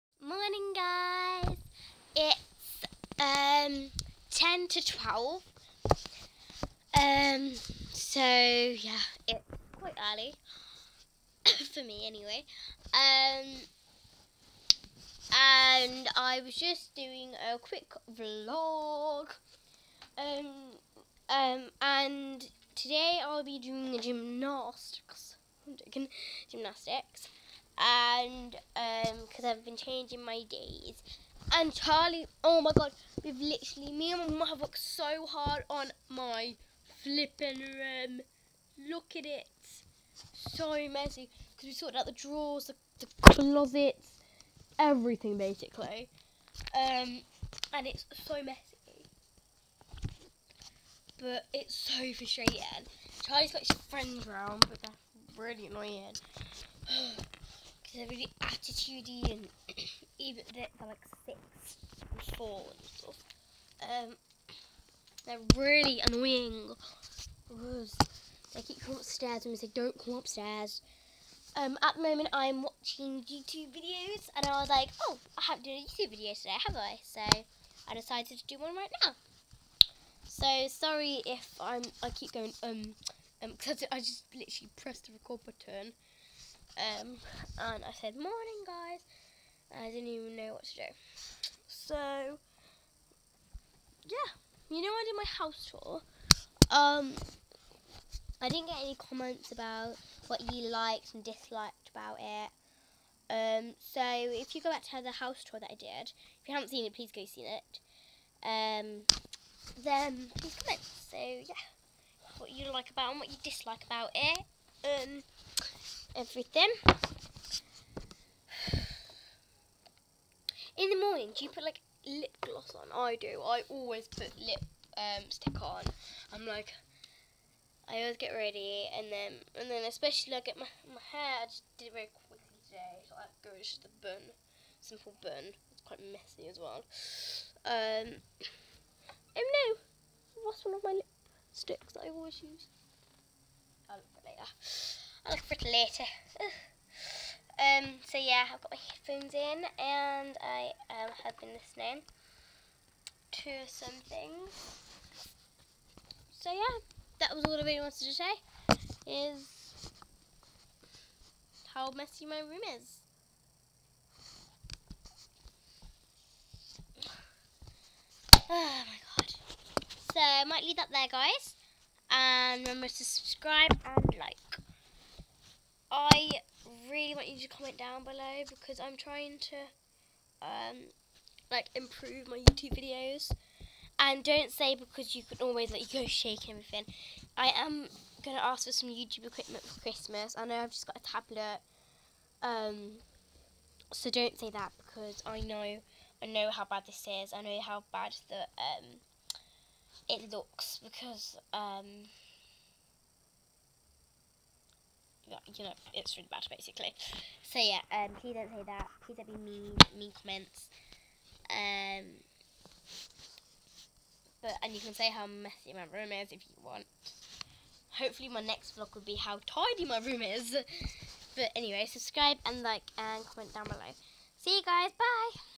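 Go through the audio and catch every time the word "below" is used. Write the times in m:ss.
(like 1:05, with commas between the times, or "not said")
2:58, 3:43.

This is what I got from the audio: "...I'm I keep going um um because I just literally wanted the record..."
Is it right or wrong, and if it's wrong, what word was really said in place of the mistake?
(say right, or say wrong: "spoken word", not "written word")
wrong: "pressed", not "wanted".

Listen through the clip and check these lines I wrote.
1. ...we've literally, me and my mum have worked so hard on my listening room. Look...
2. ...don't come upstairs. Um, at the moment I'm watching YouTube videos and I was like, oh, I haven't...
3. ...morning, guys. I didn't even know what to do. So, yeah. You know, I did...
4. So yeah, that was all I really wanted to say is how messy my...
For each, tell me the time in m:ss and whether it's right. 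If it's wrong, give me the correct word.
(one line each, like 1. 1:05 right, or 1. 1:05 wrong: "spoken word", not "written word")
1. 0:33 wrong: "flipping", not "listening"
2. 1:09 right
3. 1:28 right
4. 2:36 right.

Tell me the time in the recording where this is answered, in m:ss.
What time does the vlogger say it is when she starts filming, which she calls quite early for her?
0:04.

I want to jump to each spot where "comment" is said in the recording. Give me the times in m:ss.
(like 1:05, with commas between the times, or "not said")
1:38, 1:50, 2:57, 3:30, 3:43.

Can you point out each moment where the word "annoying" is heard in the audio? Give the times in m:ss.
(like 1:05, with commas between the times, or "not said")
0:55, 1:06.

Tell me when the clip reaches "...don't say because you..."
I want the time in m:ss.
3:04.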